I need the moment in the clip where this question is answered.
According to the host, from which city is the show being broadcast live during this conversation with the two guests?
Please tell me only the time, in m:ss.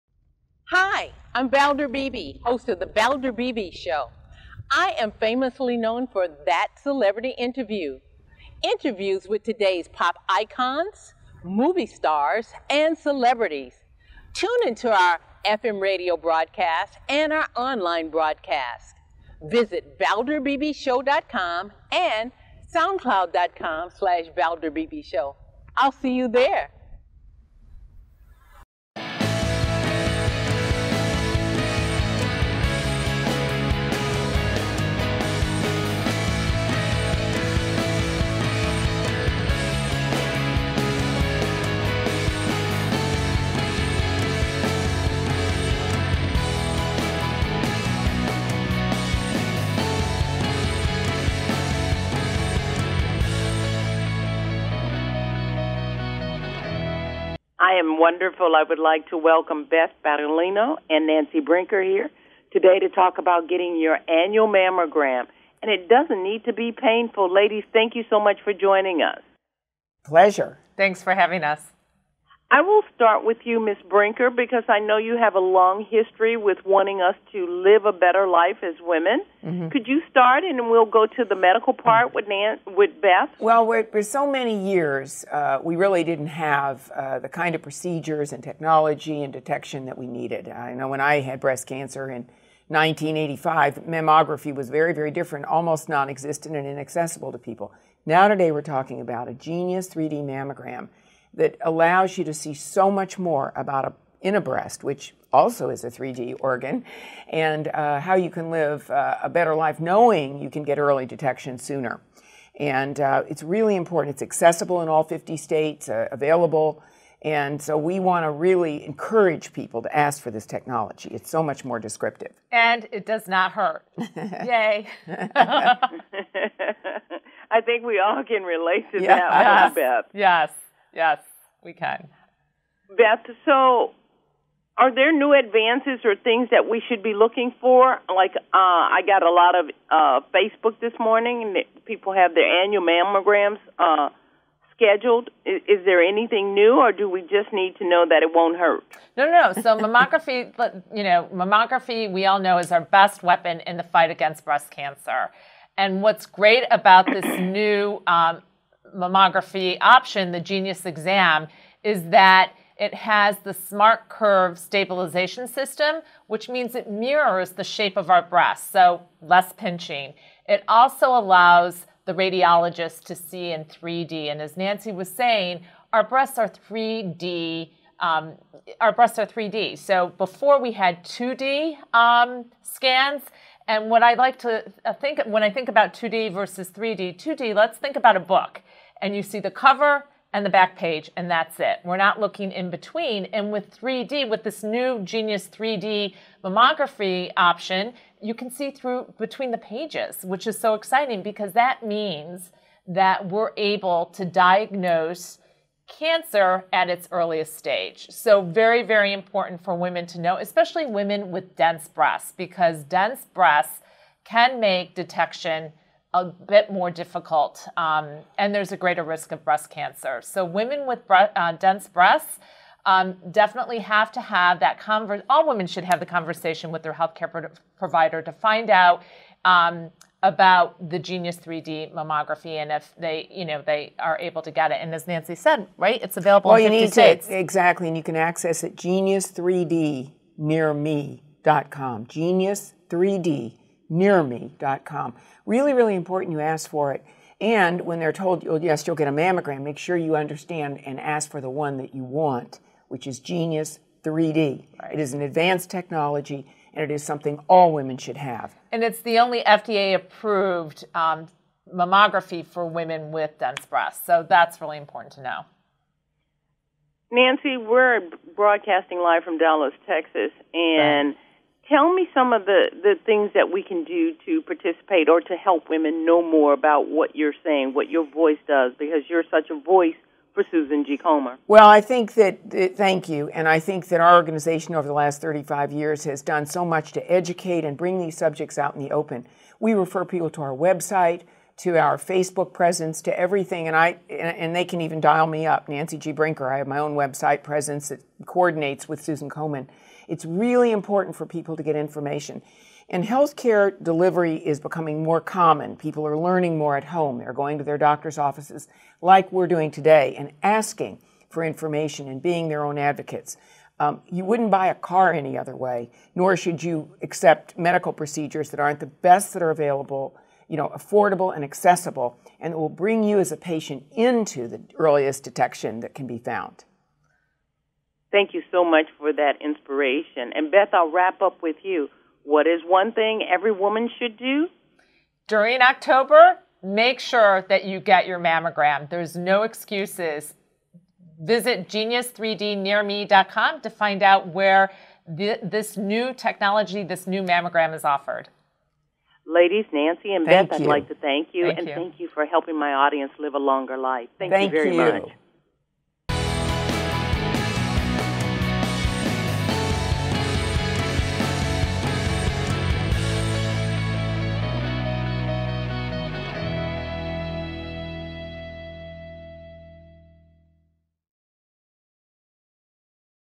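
4:29.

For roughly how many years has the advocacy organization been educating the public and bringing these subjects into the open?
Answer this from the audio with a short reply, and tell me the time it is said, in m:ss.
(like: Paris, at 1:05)
35 years, at 4:45.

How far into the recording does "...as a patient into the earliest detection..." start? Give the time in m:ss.
5:23.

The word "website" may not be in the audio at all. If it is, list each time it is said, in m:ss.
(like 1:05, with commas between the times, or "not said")
4:50, 4:56.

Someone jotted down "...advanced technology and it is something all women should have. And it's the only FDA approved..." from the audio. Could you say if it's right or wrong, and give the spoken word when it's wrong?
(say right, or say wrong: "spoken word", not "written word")
right.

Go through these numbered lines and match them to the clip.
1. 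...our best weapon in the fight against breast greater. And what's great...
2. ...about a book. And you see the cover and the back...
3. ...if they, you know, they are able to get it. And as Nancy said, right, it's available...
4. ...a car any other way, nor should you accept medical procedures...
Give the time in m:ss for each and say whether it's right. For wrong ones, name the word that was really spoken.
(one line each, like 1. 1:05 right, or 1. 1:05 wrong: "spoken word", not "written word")
1. 2:32 wrong: "cancer", not "greater"
2. 3:07 right
3. 3:52 right
4. 5:14 right.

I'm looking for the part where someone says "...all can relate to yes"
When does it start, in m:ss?
2:07.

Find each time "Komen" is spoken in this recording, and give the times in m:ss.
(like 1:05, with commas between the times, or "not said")
4:40, 4:59.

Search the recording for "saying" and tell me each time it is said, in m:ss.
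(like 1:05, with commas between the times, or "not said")
2:55, 4:37.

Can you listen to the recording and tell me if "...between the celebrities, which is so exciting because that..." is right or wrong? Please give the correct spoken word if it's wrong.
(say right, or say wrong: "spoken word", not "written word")
wrong: "pages", not "celebrities".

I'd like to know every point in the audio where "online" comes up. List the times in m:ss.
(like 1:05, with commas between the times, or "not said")
0:17.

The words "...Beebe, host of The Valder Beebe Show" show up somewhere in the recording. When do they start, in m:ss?
0:01.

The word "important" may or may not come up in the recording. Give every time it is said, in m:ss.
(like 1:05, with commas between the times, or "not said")
1:53, 3:29, 4:05, 4:24, 5:00.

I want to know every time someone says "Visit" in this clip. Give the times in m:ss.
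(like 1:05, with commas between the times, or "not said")
0:19, 5:41.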